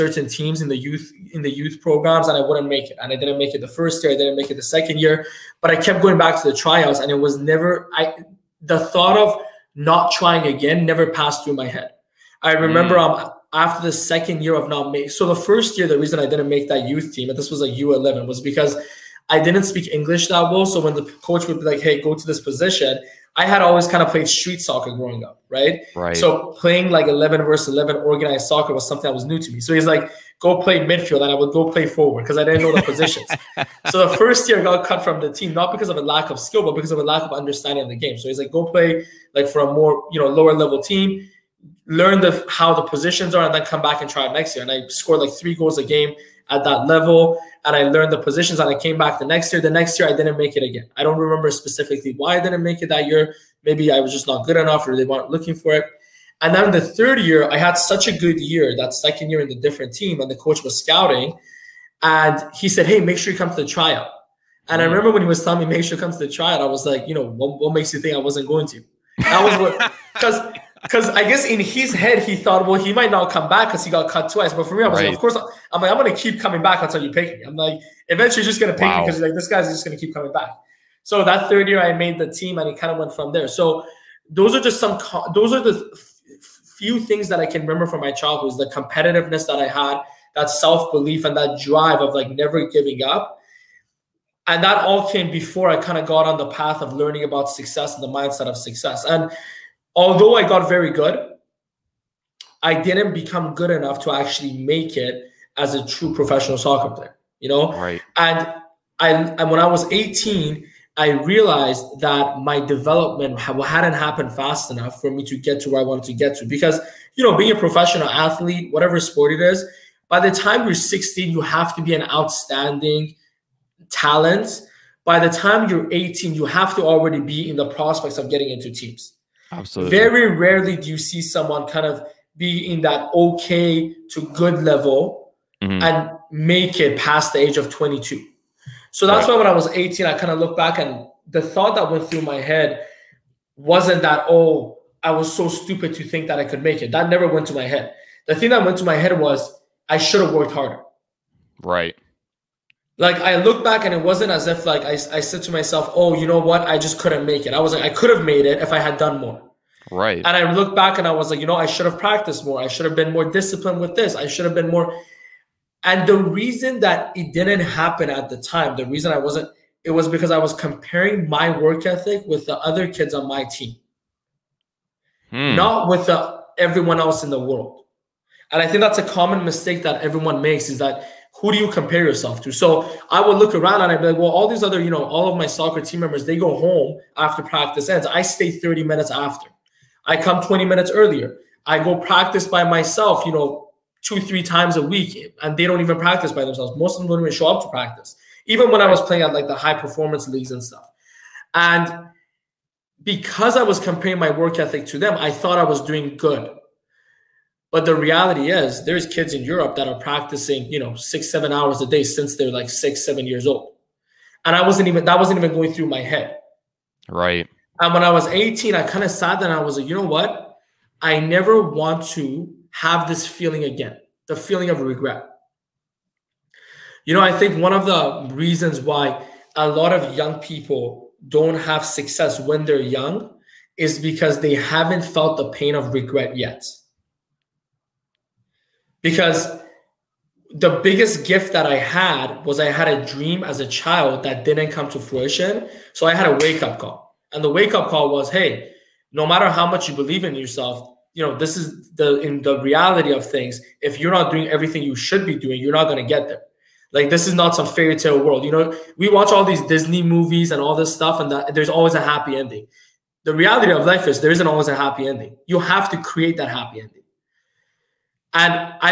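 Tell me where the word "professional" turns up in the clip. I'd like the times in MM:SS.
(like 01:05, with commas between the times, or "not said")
01:46, 01:57.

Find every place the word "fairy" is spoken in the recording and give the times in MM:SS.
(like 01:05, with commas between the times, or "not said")
04:17.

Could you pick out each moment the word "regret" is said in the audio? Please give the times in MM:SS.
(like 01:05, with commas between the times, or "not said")
03:44, 03:55.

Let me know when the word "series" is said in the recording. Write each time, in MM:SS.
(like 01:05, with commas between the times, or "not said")
not said.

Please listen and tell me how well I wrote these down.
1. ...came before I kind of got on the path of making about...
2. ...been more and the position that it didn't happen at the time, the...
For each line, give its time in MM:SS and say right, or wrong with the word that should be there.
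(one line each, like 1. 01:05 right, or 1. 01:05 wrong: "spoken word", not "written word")
1. 01:35 wrong: "learning", not "making"
2. 02:44 wrong: "reason", not "position".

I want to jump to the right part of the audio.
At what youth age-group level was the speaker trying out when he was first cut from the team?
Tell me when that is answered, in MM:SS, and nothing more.
00:17.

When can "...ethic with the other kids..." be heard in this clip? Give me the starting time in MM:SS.
02:51.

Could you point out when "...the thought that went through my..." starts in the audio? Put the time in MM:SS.
02:21.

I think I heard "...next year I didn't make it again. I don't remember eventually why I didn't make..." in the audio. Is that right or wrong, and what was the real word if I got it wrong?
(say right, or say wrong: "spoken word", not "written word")
wrong: "specifically", not "eventually".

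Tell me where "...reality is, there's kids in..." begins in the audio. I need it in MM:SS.
03:27.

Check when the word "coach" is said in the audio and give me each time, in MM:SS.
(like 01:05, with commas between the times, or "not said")
00:21, 01:00.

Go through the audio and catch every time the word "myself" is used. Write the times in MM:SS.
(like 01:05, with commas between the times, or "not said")
02:35, 03:12.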